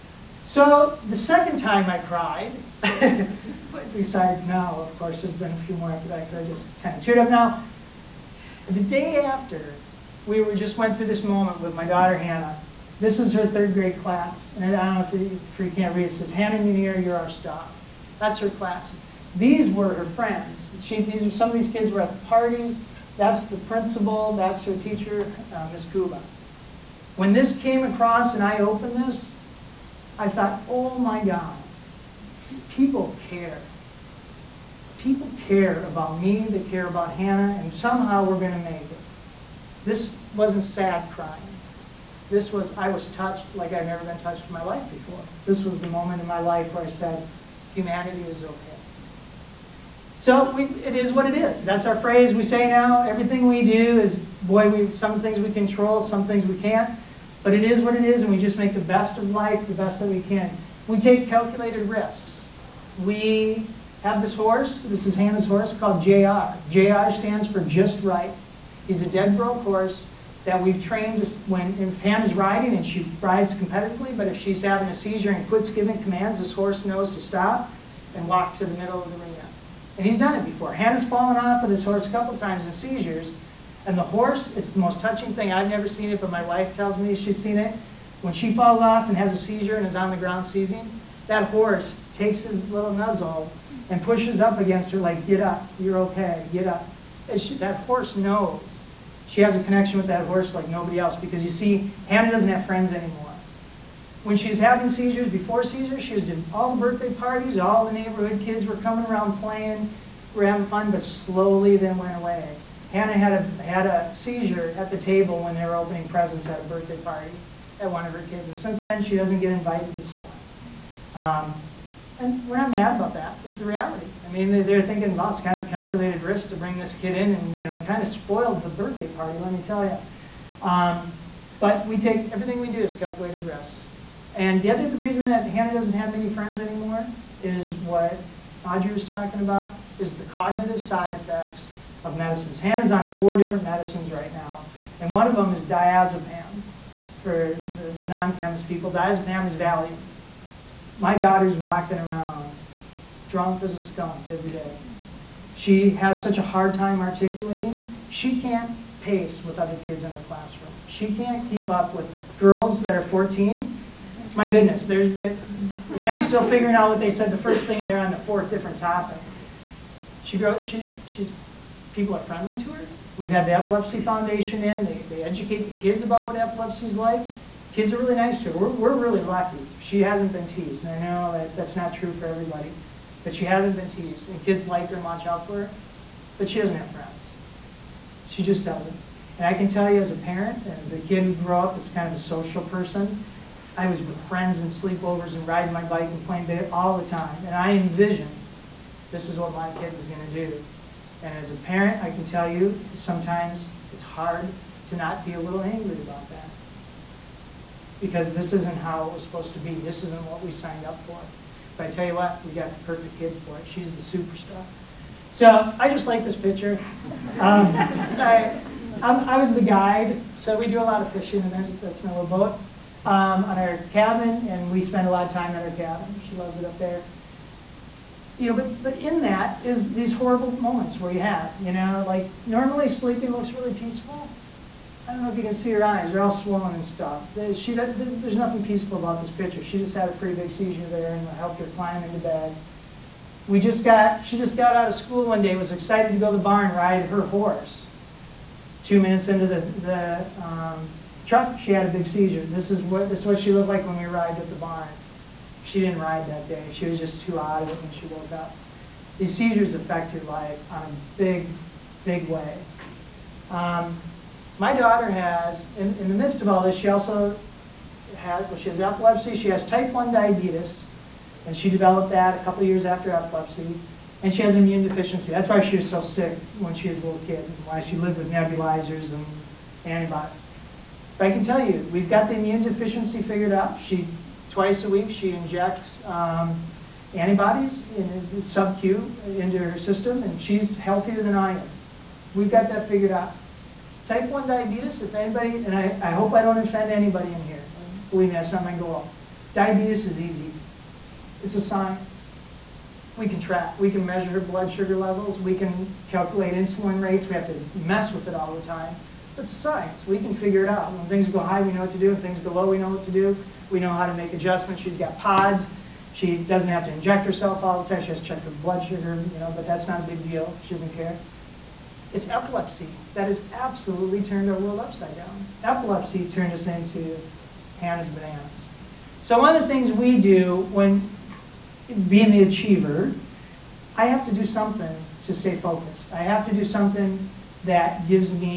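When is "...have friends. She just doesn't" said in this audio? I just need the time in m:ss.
3:06.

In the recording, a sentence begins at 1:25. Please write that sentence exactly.
I've never seen it, but my wife tells me she's seen it.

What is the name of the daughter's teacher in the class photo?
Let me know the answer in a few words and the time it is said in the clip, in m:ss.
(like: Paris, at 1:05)
Miss Cuba, at 0:25.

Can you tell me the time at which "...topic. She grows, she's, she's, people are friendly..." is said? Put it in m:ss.
2:48.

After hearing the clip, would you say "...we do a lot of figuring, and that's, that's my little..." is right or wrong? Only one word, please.
wrong.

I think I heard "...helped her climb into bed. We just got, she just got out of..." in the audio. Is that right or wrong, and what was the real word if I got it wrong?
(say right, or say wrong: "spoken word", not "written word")
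right.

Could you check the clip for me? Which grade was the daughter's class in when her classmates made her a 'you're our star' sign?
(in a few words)
Third grade.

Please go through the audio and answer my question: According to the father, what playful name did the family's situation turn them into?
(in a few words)
Hannah's bananas.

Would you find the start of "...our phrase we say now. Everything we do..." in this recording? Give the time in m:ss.
0:51.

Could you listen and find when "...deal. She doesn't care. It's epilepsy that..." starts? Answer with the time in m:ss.
5:20.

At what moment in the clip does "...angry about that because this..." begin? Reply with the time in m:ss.
3:25.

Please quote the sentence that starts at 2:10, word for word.
Um, but we take, everything we do is calculated risk.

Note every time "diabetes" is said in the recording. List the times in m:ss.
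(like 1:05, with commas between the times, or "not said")
4:30, 4:54, 4:59.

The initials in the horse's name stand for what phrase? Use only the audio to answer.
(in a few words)
Just right.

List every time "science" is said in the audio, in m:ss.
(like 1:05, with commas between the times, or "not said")
5:01, 5:09.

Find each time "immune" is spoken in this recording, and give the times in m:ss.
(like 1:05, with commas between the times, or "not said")
4:34, 4:42.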